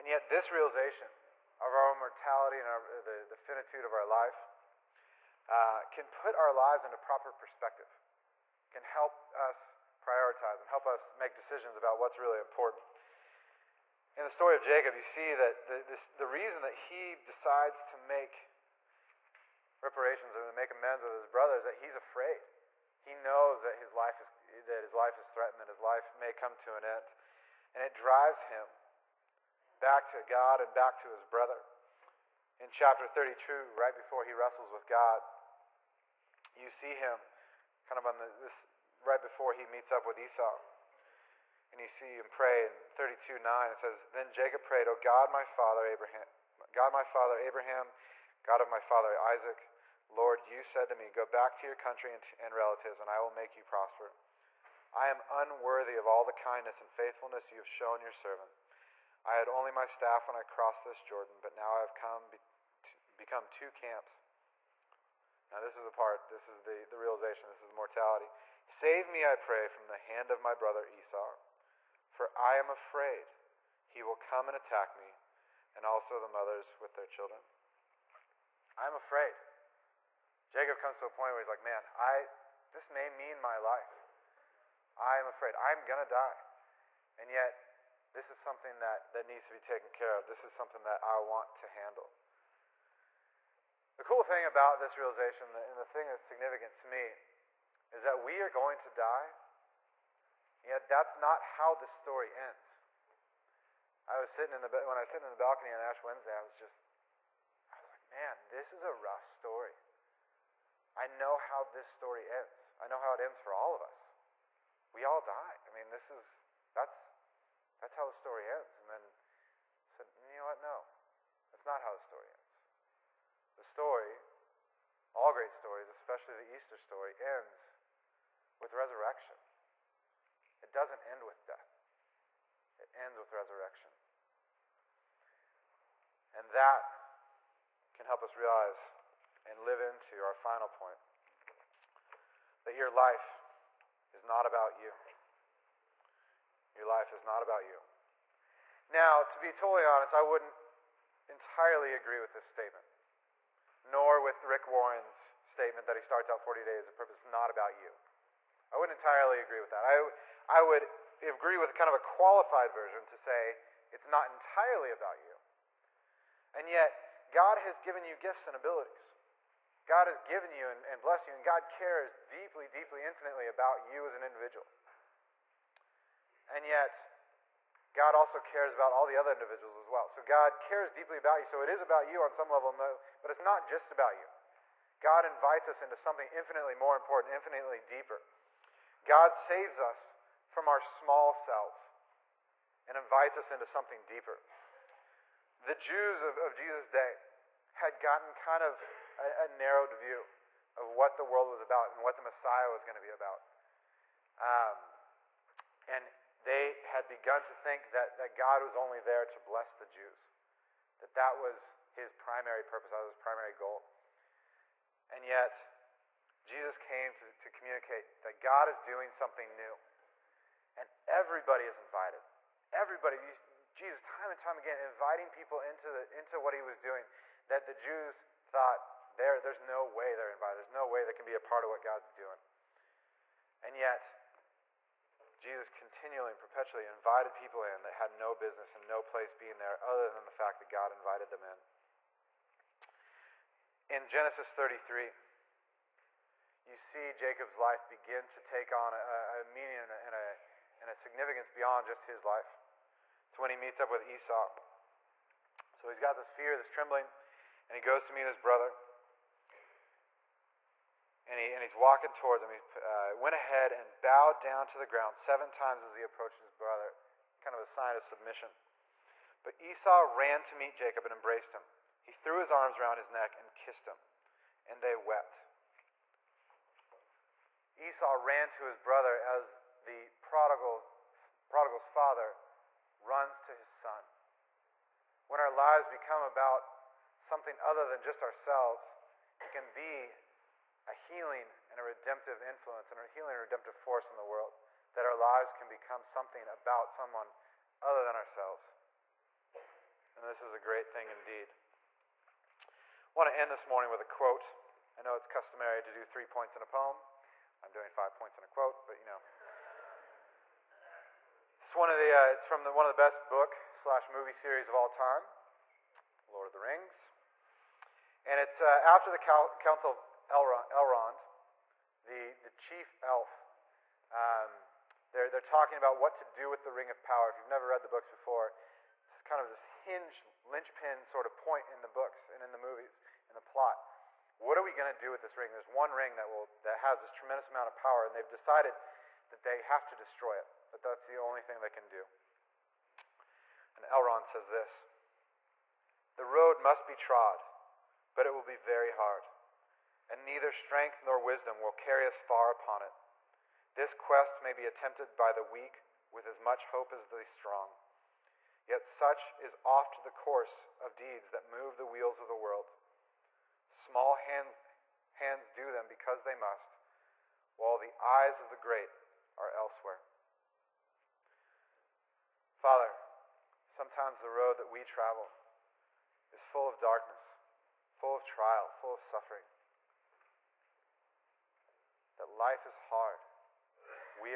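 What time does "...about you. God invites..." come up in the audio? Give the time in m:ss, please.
3:03.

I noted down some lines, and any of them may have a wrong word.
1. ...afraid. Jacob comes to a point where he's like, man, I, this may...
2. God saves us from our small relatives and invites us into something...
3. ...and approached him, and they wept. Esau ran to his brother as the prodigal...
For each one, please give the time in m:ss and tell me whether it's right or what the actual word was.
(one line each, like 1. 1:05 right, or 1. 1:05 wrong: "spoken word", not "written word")
1. 1:18 right
2. 3:09 wrong: "selves", not "relatives"
3. 4:33 wrong: "kissed", not "approached".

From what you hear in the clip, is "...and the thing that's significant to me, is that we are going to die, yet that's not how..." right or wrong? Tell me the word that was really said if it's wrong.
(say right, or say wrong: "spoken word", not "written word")
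right.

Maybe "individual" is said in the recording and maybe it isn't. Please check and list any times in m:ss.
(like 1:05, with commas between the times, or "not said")
2:54, 2:59.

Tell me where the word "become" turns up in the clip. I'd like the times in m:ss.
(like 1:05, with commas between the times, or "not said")
1:03, 4:45, 4:55.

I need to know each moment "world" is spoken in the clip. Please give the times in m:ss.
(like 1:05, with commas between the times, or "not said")
3:21, 4:54, 6:02.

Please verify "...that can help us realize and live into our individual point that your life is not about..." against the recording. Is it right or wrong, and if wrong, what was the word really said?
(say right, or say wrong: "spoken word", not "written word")
wrong: "final", not "individual".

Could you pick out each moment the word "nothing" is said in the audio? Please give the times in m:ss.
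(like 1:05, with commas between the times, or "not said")
not said.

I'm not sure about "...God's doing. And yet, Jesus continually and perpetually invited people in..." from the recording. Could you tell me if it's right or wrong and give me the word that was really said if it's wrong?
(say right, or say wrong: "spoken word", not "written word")
right.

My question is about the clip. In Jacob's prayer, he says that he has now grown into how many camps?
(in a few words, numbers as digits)
2.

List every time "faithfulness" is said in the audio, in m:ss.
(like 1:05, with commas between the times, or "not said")
0:56.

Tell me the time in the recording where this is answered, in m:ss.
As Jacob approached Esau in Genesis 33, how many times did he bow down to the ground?
4:25.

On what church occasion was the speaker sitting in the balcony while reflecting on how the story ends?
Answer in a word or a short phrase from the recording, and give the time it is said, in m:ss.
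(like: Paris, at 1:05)
Ash Wednesday, at 1:45.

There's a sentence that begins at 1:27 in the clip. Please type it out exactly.
And yet, this is something that, that needs to be taken care of.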